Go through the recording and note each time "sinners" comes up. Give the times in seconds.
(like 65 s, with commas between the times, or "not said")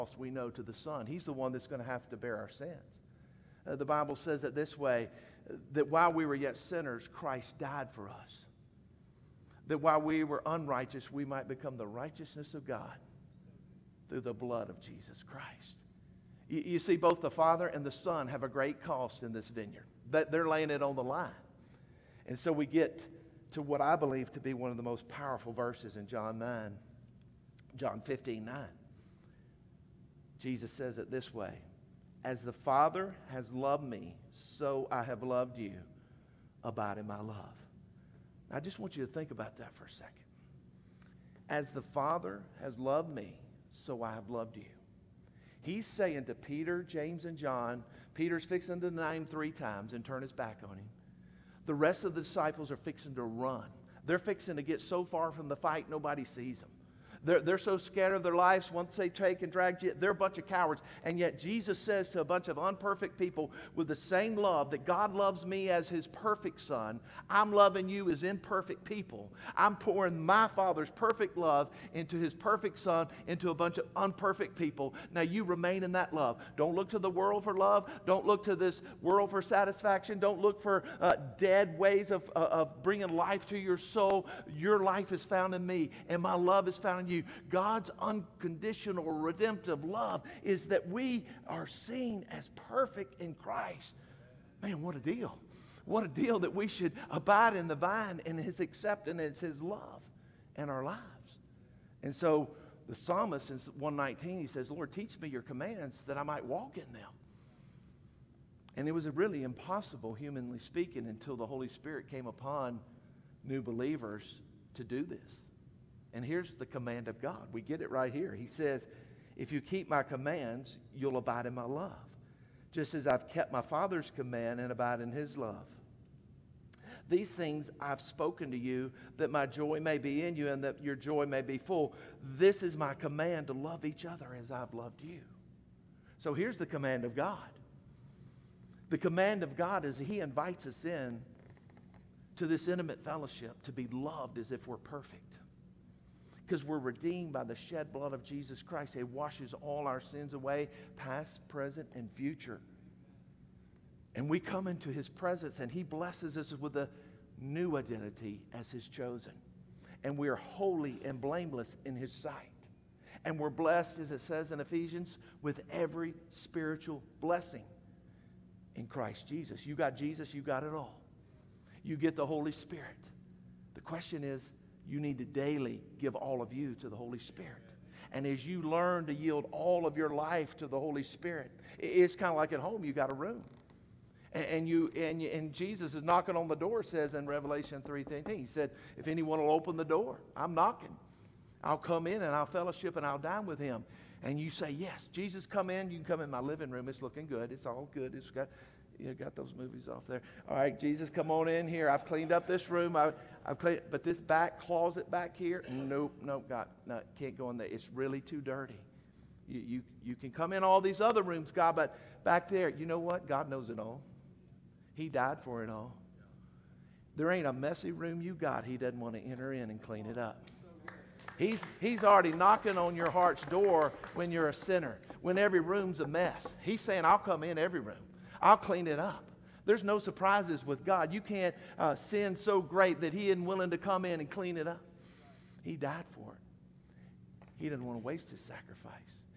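6 s, 224 s.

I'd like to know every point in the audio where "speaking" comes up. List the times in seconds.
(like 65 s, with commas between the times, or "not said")
110 s.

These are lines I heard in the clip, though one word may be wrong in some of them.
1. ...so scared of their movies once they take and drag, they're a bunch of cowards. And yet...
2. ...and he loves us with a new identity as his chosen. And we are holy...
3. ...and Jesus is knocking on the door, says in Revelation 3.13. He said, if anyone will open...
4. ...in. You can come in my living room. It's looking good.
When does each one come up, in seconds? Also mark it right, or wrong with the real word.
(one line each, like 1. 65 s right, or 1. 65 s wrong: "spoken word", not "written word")
1. 57 s wrong: "lives", not "movies"
2. 155 s wrong: "blesses", not "loves"
3. 185 s right
4. 195 s right.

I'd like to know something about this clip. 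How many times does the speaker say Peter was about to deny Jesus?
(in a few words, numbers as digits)
3.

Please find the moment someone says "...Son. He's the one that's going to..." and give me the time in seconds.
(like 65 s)
0 s.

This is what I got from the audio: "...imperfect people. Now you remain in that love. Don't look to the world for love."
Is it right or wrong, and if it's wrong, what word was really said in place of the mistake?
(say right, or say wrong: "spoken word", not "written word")
wrong: "unperfect", not "imperfect".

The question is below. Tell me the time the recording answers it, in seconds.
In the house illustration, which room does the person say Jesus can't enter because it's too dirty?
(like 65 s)
204 s.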